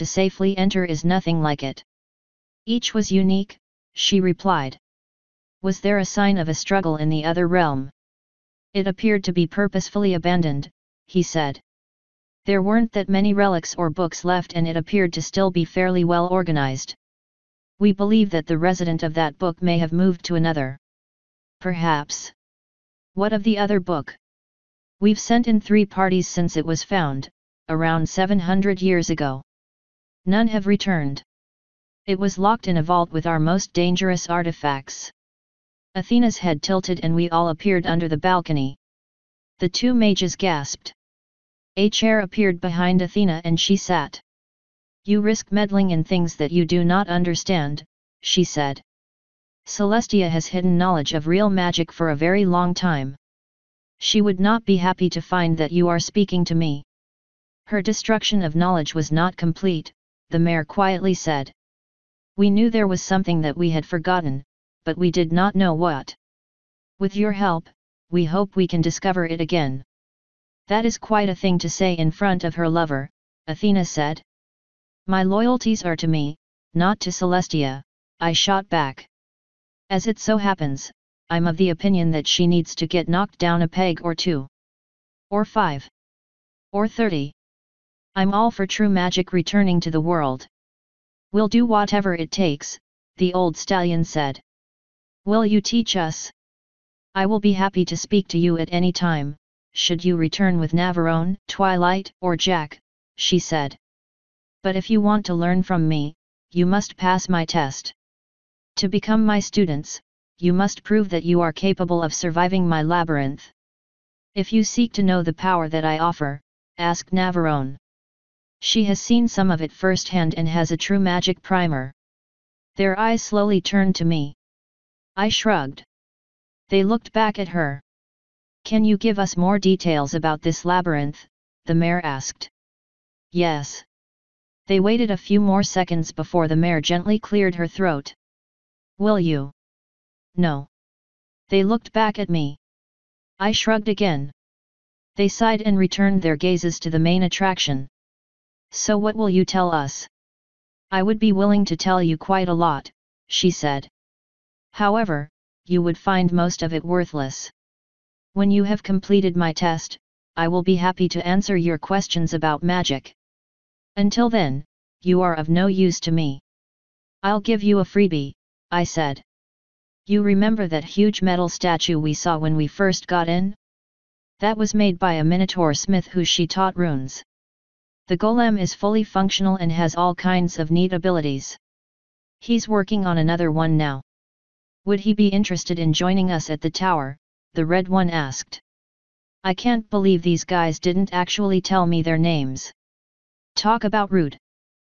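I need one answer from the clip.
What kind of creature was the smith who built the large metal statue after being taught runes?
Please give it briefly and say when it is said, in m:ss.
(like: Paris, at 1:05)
Minotaur, at 2:55.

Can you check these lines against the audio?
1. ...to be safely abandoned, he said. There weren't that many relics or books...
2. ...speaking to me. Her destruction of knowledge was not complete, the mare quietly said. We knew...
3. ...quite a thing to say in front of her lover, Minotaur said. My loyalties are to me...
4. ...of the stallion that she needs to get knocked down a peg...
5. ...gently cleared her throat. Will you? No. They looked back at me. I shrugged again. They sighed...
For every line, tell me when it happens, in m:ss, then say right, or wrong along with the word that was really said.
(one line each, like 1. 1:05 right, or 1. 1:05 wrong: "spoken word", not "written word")
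1. 0:09 wrong: "purposefully", not "safely"
2. 0:55 right
3. 1:10 wrong: "Athena", not "Minotaur"
4. 1:21 wrong: "opinion", not "stallion"
5. 2:16 right.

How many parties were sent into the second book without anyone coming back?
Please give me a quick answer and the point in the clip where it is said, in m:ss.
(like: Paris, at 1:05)
3, at 0:25.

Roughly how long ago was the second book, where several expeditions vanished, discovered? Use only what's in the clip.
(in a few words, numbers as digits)
700 years.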